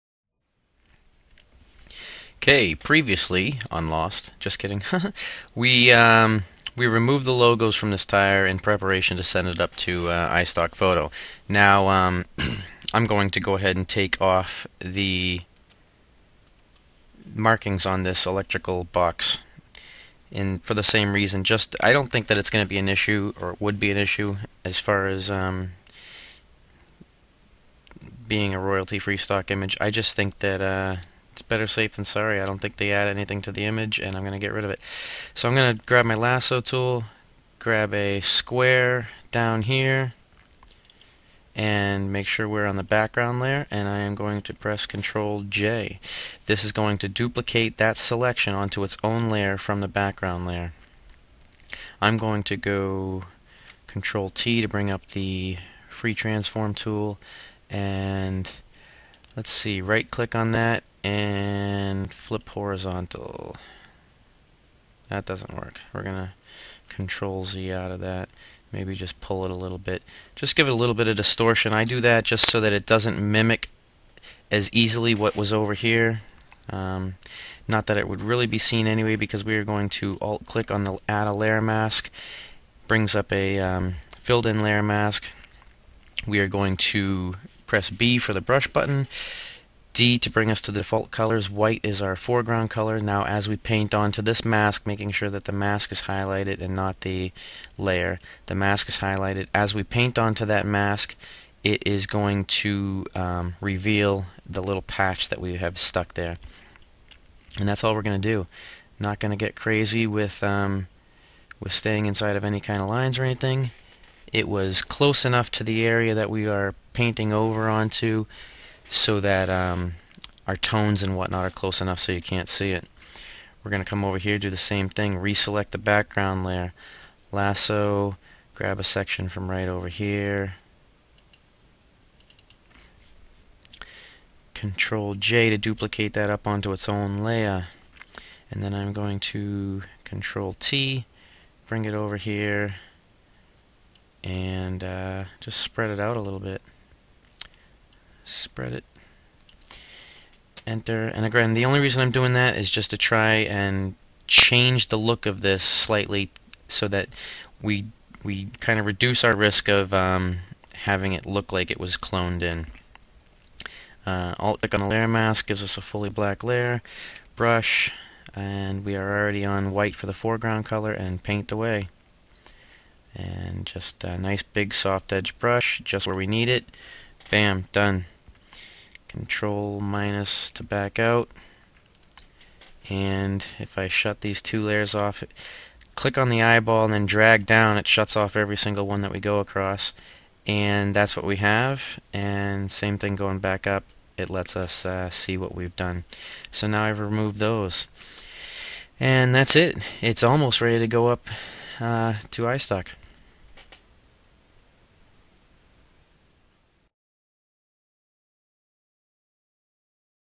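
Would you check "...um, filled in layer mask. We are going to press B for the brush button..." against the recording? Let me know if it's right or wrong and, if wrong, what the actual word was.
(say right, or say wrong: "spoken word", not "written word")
right.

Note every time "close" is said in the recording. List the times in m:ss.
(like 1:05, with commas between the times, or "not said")
1:54, 2:01.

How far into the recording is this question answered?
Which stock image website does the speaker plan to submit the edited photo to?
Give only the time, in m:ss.
0:10.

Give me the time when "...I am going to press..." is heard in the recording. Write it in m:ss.
0:43.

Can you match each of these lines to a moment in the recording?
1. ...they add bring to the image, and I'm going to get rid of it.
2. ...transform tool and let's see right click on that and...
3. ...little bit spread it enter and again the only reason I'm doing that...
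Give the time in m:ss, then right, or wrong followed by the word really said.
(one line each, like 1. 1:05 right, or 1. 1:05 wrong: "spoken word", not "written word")
1. 0:32 wrong: "anything", not "bring"
2. 0:56 right
3. 2:26 right.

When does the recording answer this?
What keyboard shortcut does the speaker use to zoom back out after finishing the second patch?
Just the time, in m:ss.
2:59.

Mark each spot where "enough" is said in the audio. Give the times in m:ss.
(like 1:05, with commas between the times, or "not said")
1:55, 2:01.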